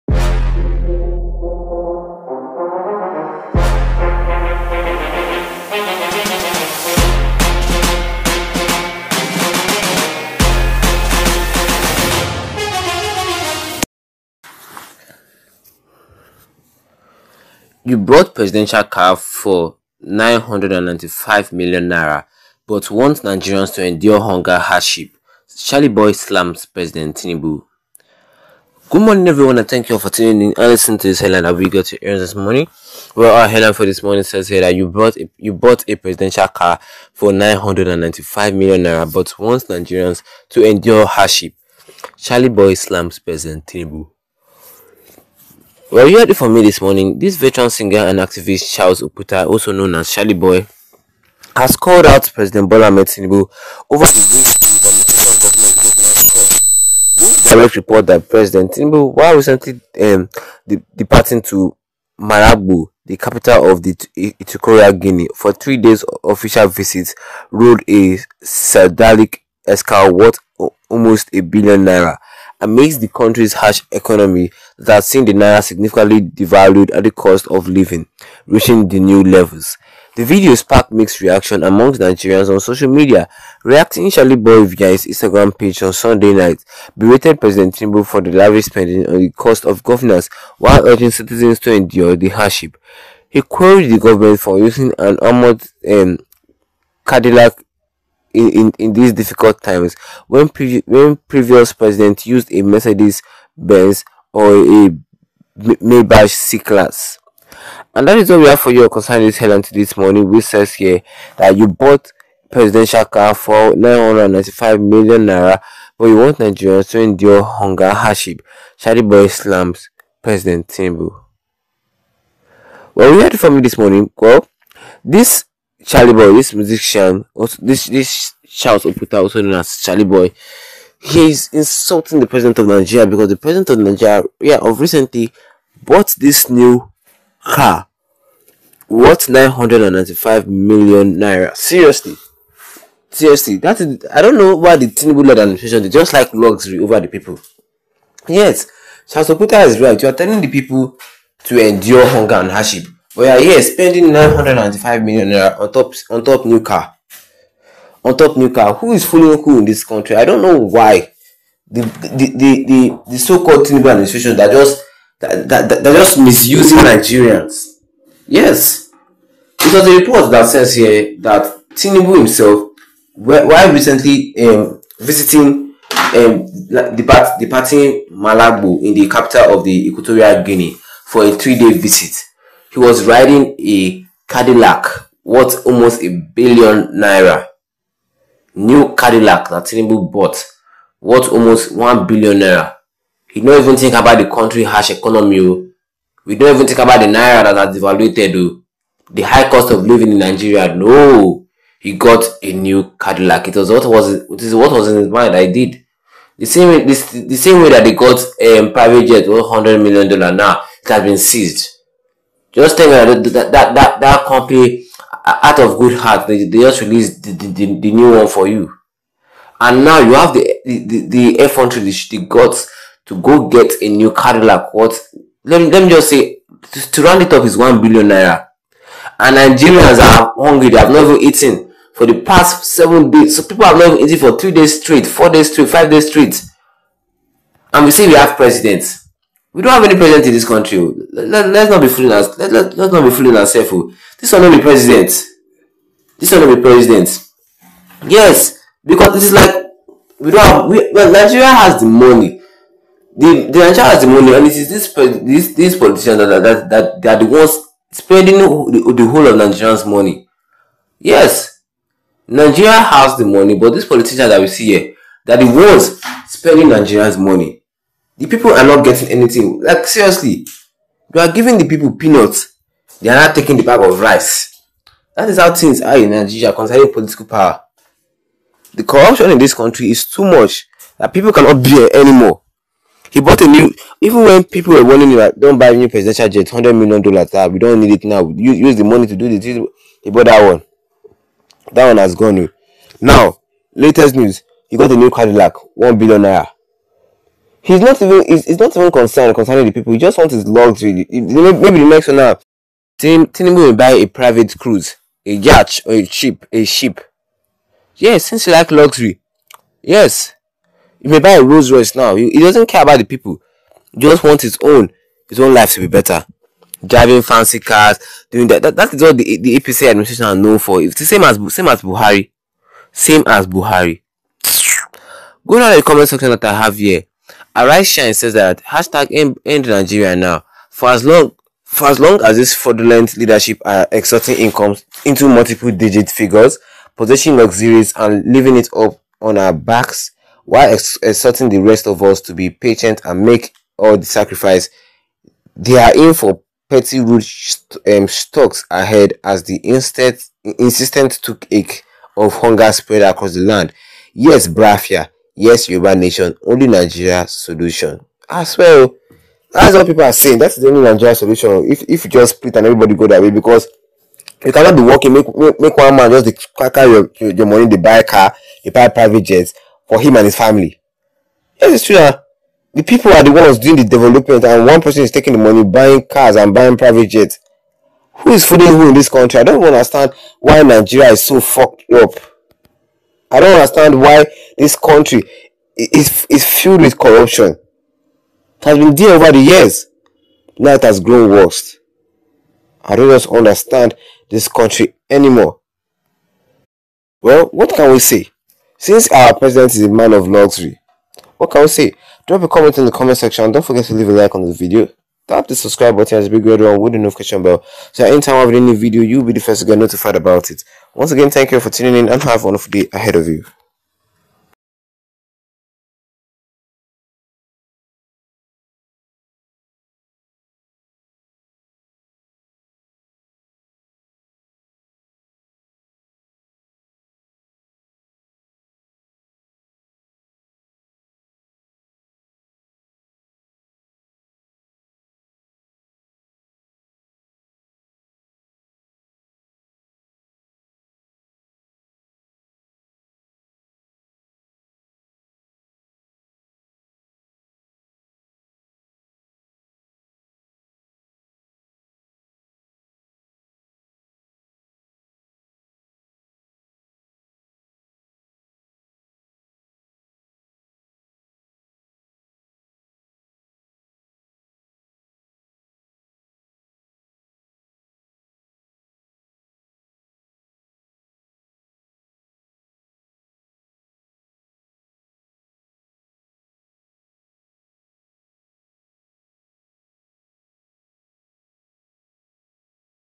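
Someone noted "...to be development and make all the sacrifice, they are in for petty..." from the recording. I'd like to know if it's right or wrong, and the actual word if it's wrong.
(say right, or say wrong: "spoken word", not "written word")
wrong: "patient", not "development".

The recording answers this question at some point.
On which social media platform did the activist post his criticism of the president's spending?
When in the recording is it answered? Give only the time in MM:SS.
01:25.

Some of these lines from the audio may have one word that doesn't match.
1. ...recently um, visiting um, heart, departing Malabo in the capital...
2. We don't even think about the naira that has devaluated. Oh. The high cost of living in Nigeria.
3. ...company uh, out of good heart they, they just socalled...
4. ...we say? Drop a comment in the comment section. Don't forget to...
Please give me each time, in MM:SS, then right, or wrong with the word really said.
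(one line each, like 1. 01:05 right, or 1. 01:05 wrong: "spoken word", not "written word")
1. 02:53 wrong: "depart", not "heart"
2. 03:16 right
3. 03:34 wrong: "released", not "socalled"
4. 06:41 right.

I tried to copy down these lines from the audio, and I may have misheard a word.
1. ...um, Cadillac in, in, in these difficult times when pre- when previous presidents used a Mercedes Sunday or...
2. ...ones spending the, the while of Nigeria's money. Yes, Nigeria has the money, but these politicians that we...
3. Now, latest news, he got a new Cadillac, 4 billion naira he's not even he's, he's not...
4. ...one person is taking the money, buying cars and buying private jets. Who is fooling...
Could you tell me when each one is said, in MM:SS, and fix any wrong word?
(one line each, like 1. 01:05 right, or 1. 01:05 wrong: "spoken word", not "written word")
1. 01:35 wrong: "Benz", not "Sunday"
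2. 04:17 wrong: "whole", not "while"
3. 04:53 wrong: "1", not "4"
4. 06:14 right.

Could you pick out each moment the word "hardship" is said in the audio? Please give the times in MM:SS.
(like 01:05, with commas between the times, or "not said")
00:24, 00:41, 01:32, 01:57, 02:32.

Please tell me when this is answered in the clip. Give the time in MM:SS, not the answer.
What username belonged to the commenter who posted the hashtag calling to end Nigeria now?
05:27.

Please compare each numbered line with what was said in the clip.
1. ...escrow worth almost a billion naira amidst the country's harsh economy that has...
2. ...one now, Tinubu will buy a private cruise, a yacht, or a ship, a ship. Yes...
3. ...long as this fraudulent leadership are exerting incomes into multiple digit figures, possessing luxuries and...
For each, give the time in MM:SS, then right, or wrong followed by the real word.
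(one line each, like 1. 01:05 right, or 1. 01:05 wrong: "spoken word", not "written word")
1. 01:09 right
2. 05:02 right
3. 05:31 right.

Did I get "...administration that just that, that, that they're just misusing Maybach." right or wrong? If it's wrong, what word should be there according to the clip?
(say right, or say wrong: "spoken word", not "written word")
wrong: "Nigerians", not "Maybach".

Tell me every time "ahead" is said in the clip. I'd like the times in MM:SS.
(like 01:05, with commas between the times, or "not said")
05:48, 06:52.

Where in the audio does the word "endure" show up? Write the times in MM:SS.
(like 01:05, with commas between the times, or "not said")
00:23, 00:40, 01:31, 01:57, 02:31.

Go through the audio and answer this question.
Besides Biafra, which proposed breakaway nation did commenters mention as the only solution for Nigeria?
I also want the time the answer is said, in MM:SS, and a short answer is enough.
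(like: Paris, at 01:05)
Yoruba nation, at 05:55.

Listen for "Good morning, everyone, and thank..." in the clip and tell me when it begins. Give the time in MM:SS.
00:28.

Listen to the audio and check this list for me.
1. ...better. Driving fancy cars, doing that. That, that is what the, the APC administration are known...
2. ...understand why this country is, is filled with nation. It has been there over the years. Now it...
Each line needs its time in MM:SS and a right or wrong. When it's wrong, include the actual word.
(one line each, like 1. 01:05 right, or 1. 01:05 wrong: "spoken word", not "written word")
1. 05:15 right
2. 06:23 wrong: "corruption", not "nation".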